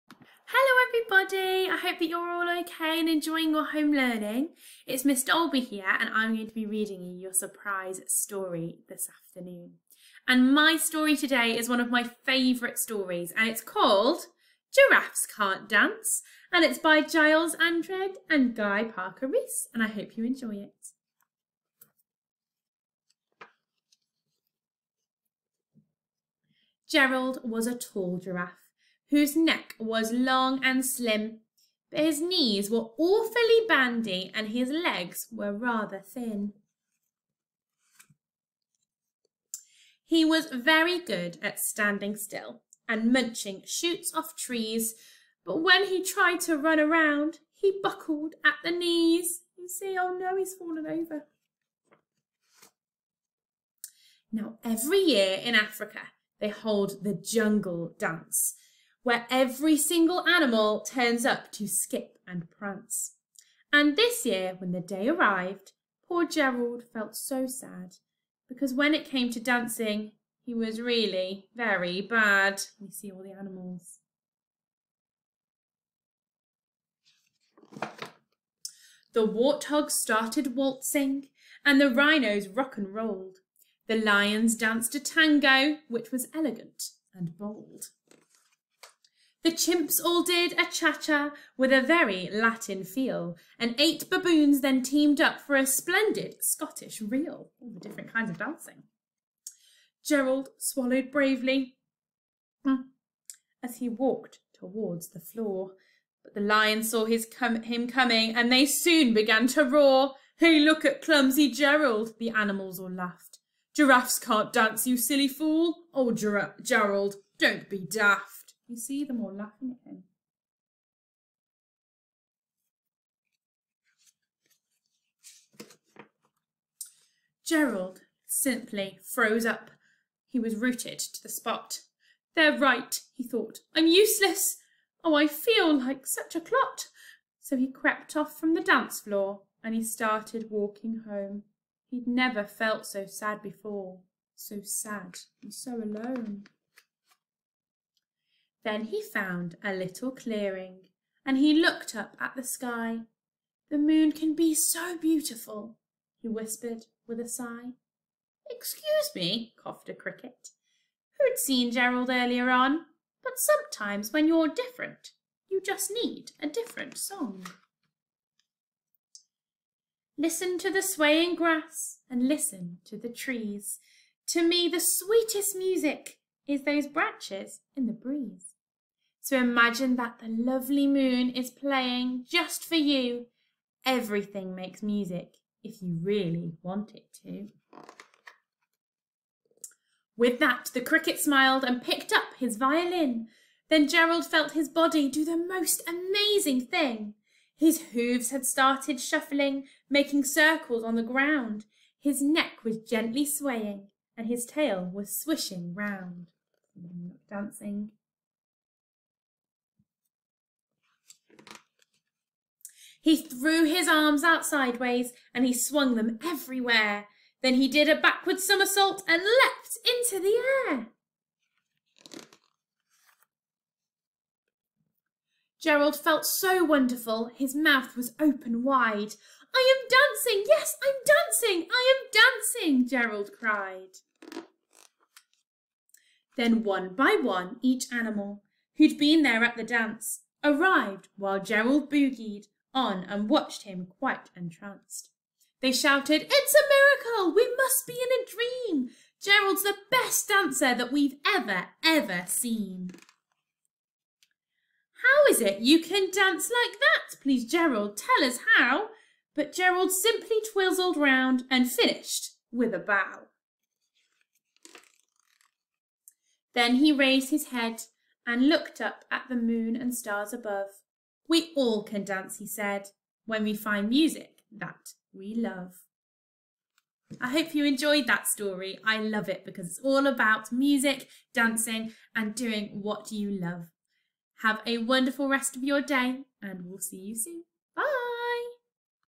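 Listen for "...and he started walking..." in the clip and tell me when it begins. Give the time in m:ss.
2:19.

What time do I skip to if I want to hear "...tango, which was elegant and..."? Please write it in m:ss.
1:24.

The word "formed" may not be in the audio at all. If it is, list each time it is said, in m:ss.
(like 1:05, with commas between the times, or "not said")
not said.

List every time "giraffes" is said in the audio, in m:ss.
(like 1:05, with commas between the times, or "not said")
0:14, 0:28, 1:53.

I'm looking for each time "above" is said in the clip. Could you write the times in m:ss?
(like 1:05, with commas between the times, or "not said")
4:30.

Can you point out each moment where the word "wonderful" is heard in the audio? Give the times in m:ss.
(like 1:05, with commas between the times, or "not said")
3:46, 4:44.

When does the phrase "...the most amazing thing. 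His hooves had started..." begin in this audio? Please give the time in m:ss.
3:15.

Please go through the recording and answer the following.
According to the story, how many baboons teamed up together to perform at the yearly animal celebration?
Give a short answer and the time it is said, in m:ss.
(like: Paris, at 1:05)
8, at 1:33.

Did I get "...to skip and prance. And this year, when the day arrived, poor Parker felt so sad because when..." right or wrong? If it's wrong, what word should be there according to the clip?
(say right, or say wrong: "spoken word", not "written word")
wrong: "Gerald", not "Parker".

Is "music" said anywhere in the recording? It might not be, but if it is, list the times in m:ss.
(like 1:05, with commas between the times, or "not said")
2:55, 3:04, 4:33, 4:40.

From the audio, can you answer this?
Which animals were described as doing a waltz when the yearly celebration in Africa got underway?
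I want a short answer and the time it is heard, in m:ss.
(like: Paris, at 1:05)
warthogs, at 1:19.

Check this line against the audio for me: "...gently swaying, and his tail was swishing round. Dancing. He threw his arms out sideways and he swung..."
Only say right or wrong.
right.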